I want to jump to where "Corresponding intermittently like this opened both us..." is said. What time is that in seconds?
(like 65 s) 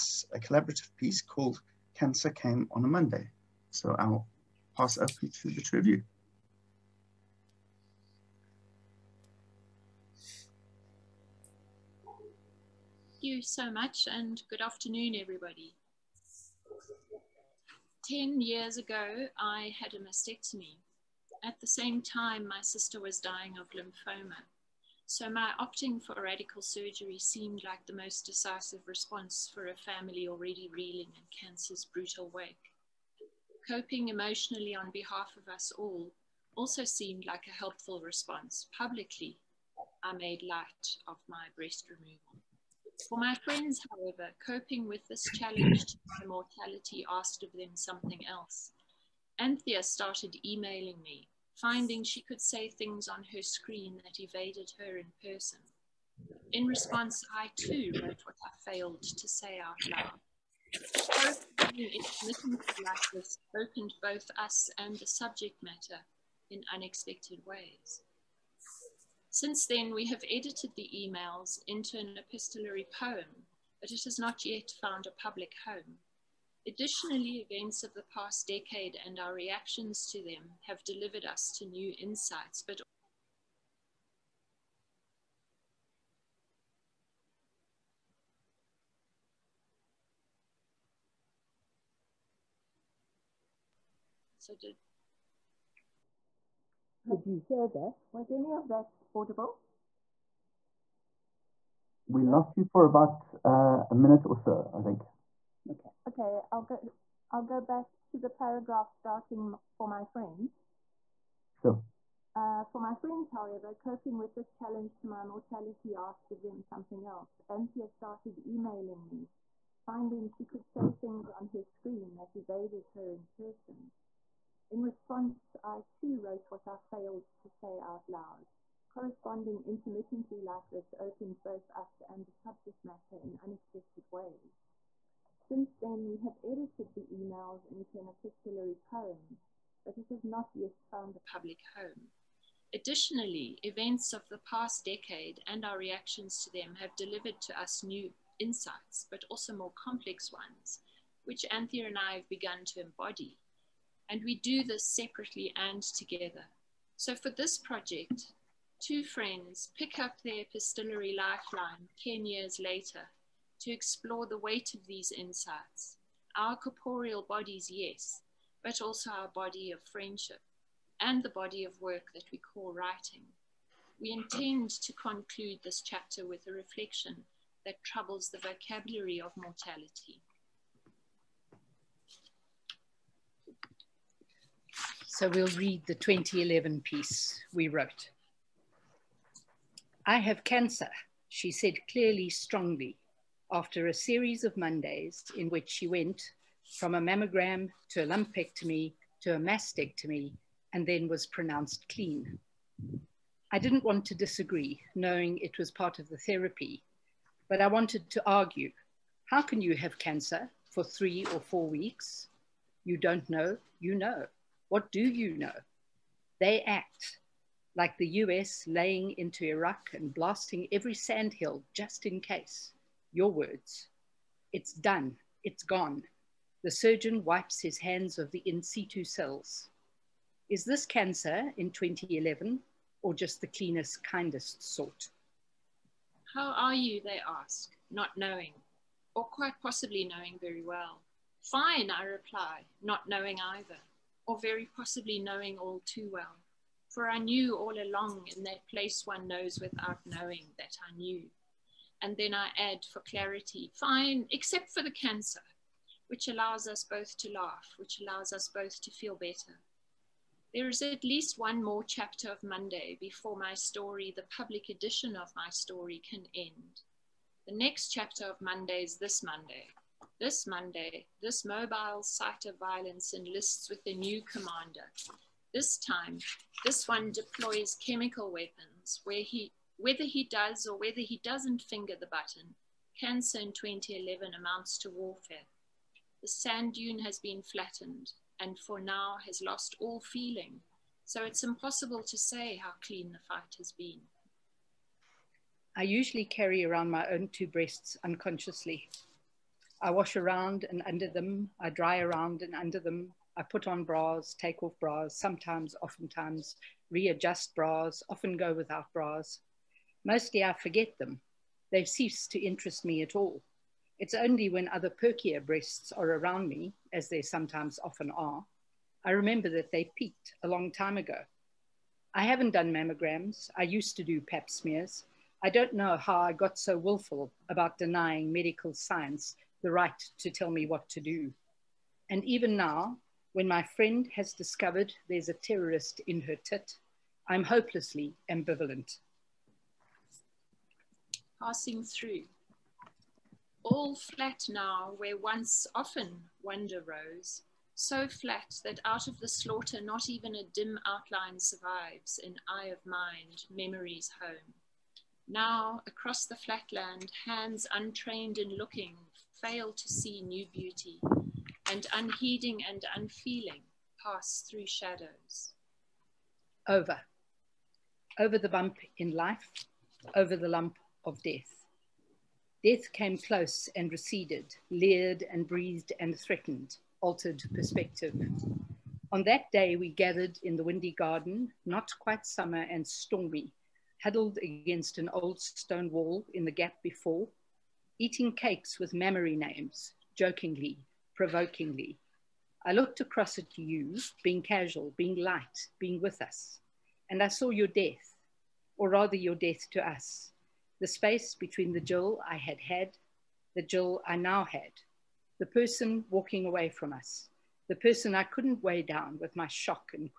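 128 s.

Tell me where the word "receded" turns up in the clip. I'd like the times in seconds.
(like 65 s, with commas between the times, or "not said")
373 s.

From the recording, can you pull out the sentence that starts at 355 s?
Now, across the flatland, hands untrained in looking fail to see new beauty, and unheeding and unfeeling pass through shadows.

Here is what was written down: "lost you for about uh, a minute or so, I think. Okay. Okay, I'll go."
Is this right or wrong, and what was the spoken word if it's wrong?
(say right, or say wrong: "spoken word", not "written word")
right.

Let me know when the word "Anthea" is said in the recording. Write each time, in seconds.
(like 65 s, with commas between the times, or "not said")
49 s, 117 s, 151 s.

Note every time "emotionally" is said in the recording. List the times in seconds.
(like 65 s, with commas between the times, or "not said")
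34 s.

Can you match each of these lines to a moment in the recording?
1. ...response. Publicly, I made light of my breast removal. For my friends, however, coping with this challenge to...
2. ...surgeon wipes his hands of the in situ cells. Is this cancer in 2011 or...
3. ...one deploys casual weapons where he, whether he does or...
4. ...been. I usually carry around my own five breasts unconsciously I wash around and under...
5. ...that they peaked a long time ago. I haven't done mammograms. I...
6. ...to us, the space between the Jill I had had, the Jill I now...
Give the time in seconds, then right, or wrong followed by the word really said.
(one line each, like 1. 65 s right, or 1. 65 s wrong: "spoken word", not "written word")
1. 38 s right
2. 226 s right
3. 276 s wrong: "chemical", not "casual"
4. 293 s wrong: "two", not "five"
5. 319 s right
6. 399 s right.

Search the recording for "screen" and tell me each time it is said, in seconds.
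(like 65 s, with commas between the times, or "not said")
53 s, 121 s.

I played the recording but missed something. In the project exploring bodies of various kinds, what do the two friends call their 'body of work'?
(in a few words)
writing.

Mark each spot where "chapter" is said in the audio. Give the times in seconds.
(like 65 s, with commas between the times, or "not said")
175 s, 261 s, 267 s.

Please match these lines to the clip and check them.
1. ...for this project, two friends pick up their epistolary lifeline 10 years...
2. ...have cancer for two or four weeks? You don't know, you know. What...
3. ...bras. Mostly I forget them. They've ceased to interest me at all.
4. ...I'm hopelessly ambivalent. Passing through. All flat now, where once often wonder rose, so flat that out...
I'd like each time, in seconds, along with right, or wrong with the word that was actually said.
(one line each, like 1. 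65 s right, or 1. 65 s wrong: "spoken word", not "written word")
1. 157 s right
2. 209 s wrong: "three", not "two"
3. 308 s right
4. 337 s right.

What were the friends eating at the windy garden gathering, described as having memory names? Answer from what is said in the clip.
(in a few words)
cakes.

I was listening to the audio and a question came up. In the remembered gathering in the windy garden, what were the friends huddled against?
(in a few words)
an old stone wall.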